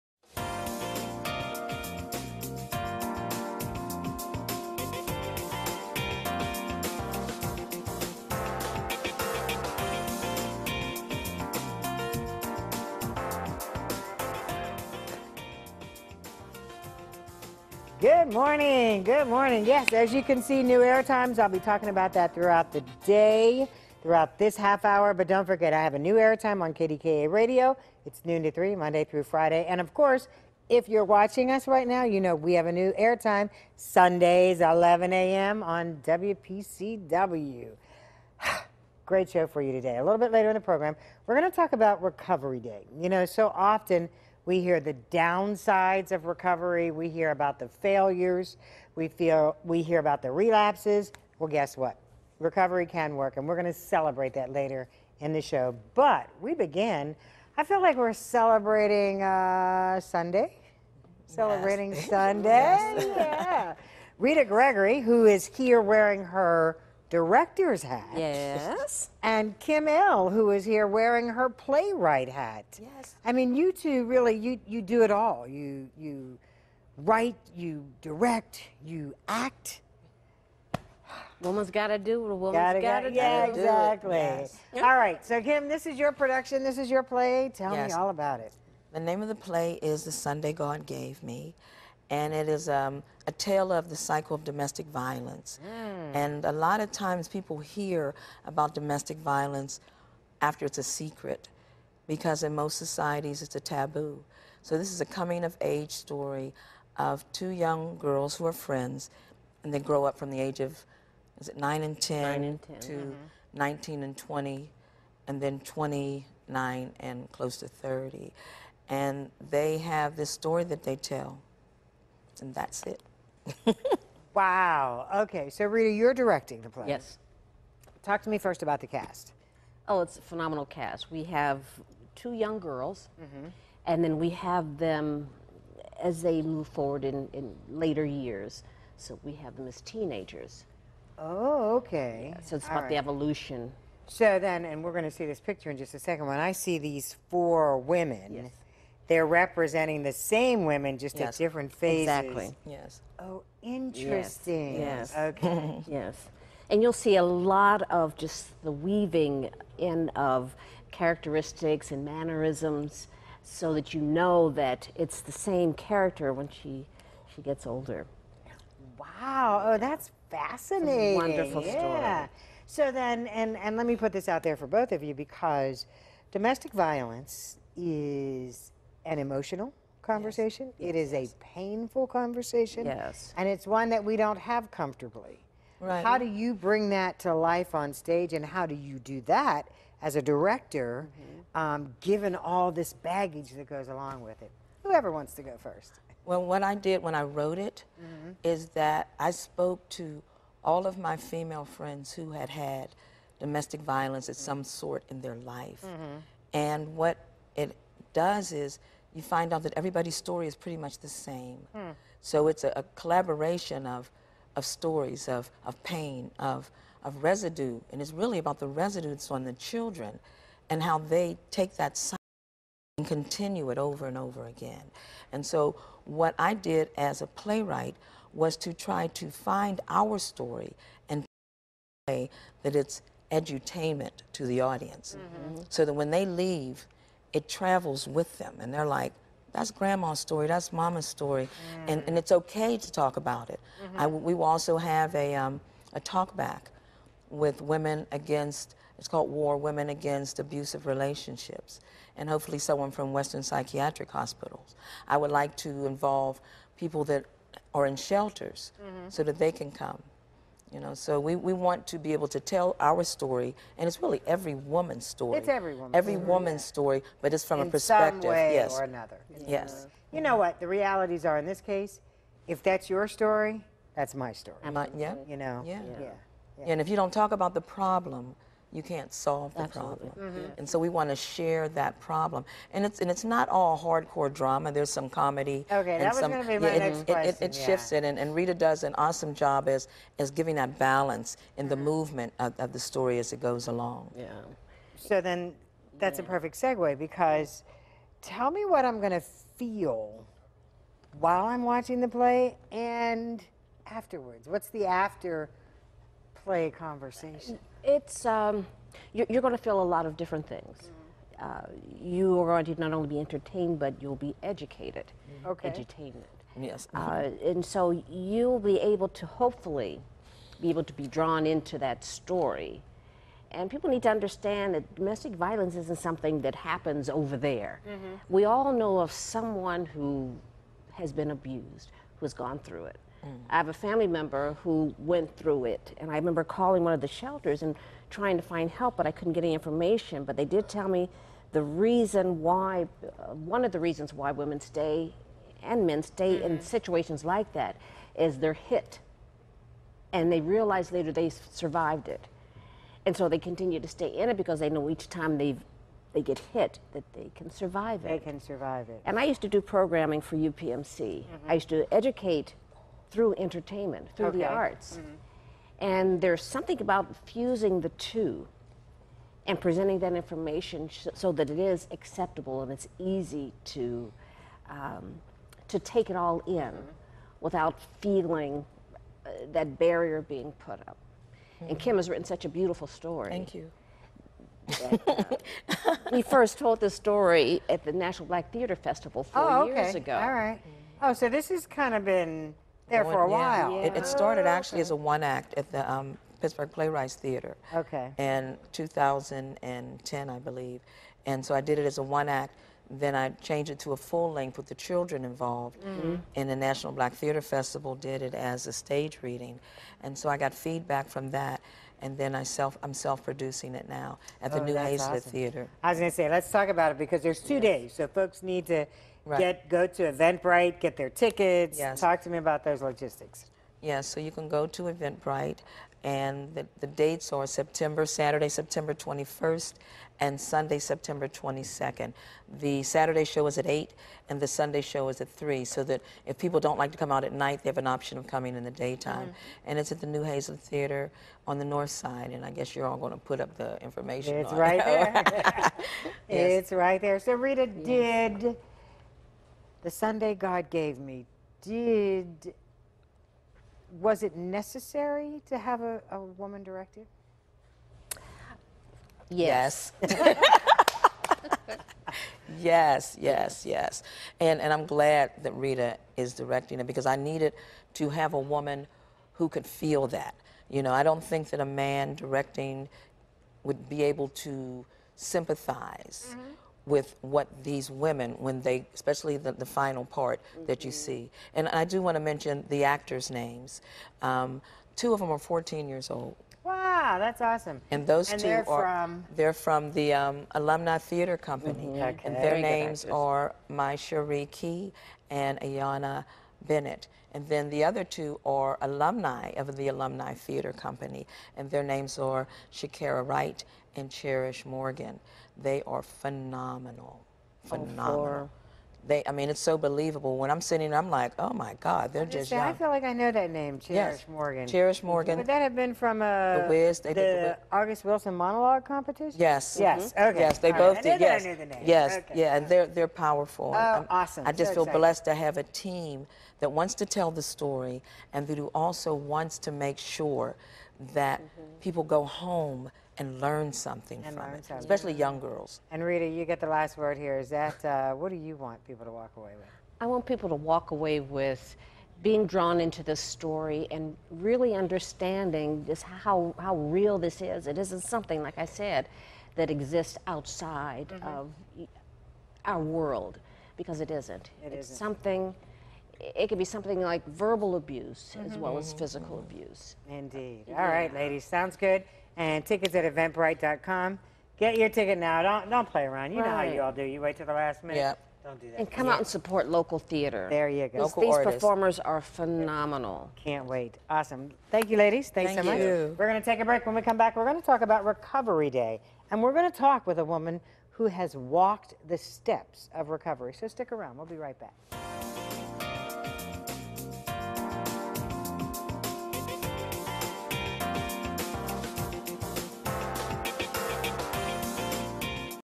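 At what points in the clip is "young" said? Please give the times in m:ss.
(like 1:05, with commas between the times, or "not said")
1:47, 2:12, 8:32, 8:55.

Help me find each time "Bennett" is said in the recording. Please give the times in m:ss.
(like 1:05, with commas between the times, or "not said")
8:16.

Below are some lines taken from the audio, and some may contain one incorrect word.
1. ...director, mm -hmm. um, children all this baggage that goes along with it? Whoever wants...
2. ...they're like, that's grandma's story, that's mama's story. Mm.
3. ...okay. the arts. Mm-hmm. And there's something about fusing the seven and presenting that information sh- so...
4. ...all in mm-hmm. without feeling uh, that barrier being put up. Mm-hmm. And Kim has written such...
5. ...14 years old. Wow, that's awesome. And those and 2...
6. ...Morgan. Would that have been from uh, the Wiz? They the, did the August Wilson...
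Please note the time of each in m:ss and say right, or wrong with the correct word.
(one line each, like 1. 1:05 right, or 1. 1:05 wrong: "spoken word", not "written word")
1. 3:10 wrong: "given", not "children"
2. 3:58 right
3. 6:04 wrong: "two", not "seven"
4. 6:16 right
5. 8:05 right
6. 8:35 right.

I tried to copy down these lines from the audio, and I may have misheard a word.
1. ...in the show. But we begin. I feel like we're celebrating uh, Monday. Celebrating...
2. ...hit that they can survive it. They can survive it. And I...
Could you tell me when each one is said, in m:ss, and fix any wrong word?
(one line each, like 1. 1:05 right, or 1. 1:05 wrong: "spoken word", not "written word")
1. 0:55 wrong: "Sunday", not "Monday"
2. 5:56 right.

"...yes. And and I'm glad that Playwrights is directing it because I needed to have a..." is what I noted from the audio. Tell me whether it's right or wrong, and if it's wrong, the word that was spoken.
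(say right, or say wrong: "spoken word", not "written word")
wrong: "Rita", not "Playwrights".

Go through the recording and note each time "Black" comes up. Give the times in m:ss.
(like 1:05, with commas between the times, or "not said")
6:28, 6:46.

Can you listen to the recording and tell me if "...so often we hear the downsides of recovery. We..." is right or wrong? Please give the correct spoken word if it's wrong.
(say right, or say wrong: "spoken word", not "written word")
right.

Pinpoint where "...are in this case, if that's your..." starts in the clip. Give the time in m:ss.
4:31.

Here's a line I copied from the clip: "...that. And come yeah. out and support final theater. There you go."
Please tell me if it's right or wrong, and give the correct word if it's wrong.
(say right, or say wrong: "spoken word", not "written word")
wrong: "local", not "final".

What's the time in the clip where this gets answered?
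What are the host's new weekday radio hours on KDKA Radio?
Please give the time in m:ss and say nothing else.
0:28.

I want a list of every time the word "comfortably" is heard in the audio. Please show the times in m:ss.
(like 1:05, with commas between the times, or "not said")
3:04.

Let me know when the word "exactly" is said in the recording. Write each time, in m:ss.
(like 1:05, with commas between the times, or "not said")
1:23, 2:32.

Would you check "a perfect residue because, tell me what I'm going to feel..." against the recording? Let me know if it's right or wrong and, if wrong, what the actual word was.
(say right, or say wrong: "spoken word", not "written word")
wrong: "segue", not "residue".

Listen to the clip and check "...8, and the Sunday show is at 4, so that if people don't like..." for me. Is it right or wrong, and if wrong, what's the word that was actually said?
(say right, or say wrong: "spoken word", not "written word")
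wrong: "3", not "4".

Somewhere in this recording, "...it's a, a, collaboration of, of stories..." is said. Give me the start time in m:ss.
3:32.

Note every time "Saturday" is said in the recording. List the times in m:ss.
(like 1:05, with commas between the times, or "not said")
7:08, 7:12.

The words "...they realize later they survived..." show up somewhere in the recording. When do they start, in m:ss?
5:50.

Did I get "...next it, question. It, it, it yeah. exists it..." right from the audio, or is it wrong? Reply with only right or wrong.
wrong.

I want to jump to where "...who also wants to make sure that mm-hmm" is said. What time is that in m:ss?
8:48.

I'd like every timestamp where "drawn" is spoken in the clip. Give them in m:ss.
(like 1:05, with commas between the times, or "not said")
5:21, 9:02.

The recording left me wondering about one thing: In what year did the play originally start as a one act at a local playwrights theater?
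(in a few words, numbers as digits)
2010.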